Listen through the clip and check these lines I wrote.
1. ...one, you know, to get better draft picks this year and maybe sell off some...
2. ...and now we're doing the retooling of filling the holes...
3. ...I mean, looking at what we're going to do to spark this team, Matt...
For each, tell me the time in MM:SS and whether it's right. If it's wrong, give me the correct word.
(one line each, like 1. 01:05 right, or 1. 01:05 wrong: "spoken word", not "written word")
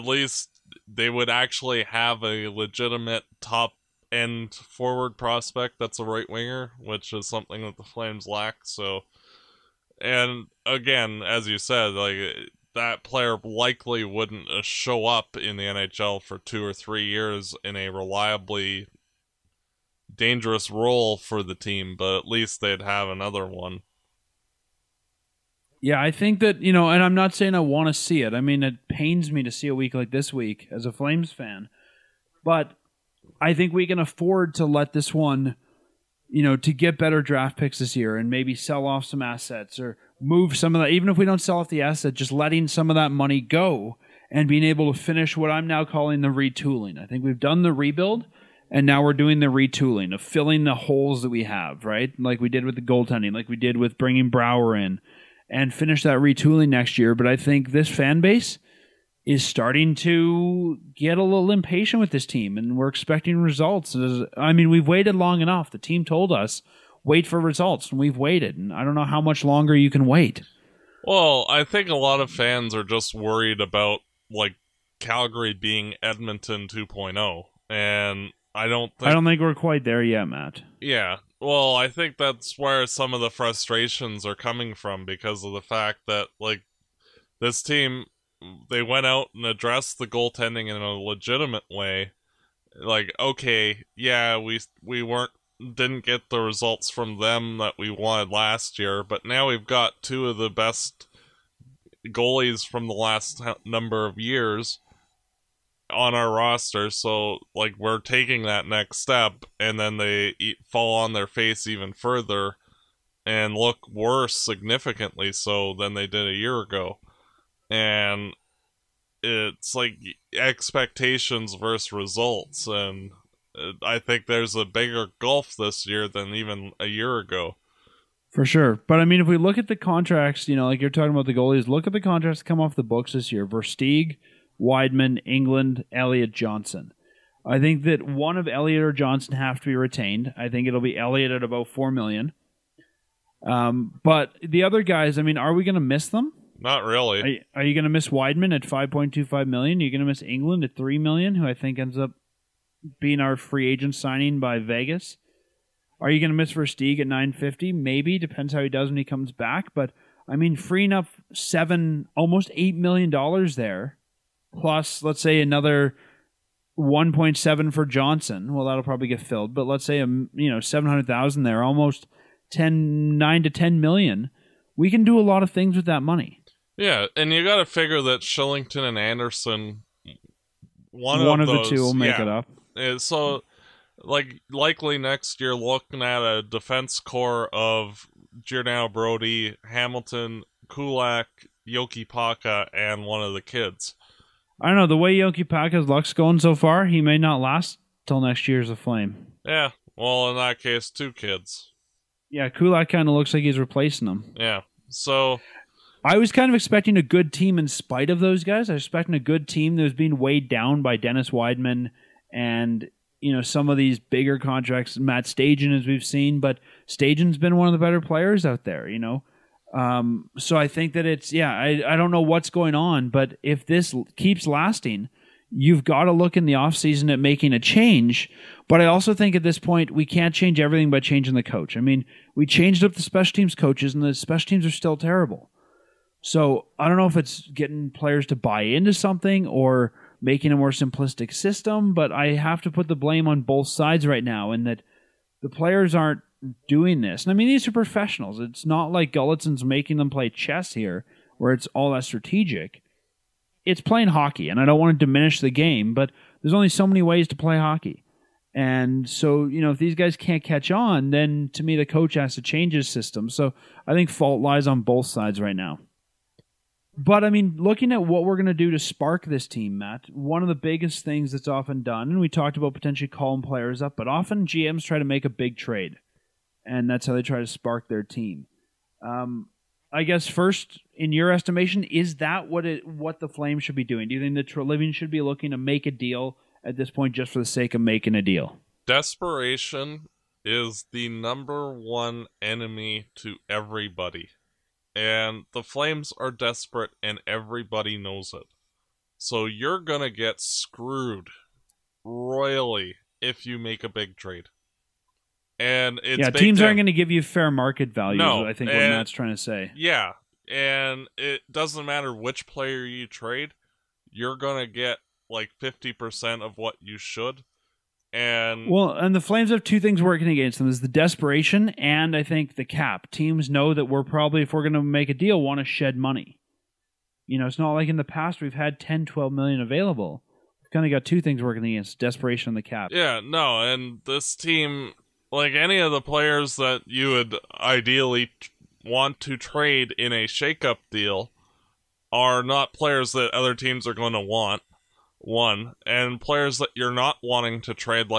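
1. 00:35 right
2. 00:48 right
3. 04:27 right.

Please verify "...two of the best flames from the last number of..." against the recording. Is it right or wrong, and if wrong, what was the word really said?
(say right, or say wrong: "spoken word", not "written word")
wrong: "goalies", not "flames".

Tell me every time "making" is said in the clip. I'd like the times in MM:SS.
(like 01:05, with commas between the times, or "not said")
03:47, 04:00, 04:09, 04:47.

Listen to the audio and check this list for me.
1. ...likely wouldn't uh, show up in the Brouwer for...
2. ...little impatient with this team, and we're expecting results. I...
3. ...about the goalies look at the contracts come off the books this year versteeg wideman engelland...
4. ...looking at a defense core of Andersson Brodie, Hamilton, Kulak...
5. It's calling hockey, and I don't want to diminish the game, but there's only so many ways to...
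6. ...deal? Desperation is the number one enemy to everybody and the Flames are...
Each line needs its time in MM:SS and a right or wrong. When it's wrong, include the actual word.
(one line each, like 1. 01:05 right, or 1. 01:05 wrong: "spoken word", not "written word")
1. 00:13 wrong: "NHL", not "Brouwer"
2. 01:01 right
3. 02:11 right
4. 03:05 wrong: "Giordano", not "Andersson"
5. 04:13 wrong: "playing", not "calling"
6. 04:48 right.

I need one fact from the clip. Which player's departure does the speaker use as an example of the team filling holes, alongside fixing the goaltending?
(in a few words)
Brouwer.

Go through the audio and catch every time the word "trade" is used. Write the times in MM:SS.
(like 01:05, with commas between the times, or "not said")
04:35, 05:04, 05:13, 05:39.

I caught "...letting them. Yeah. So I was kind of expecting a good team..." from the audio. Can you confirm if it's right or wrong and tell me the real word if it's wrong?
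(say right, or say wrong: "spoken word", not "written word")
wrong: "replacing", not "letting".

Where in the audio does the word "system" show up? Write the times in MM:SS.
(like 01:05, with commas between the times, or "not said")
04:01, 04:22.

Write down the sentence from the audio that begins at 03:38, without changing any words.
You know, um, so I think that it's yeah.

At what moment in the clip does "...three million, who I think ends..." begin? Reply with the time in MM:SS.
02:30.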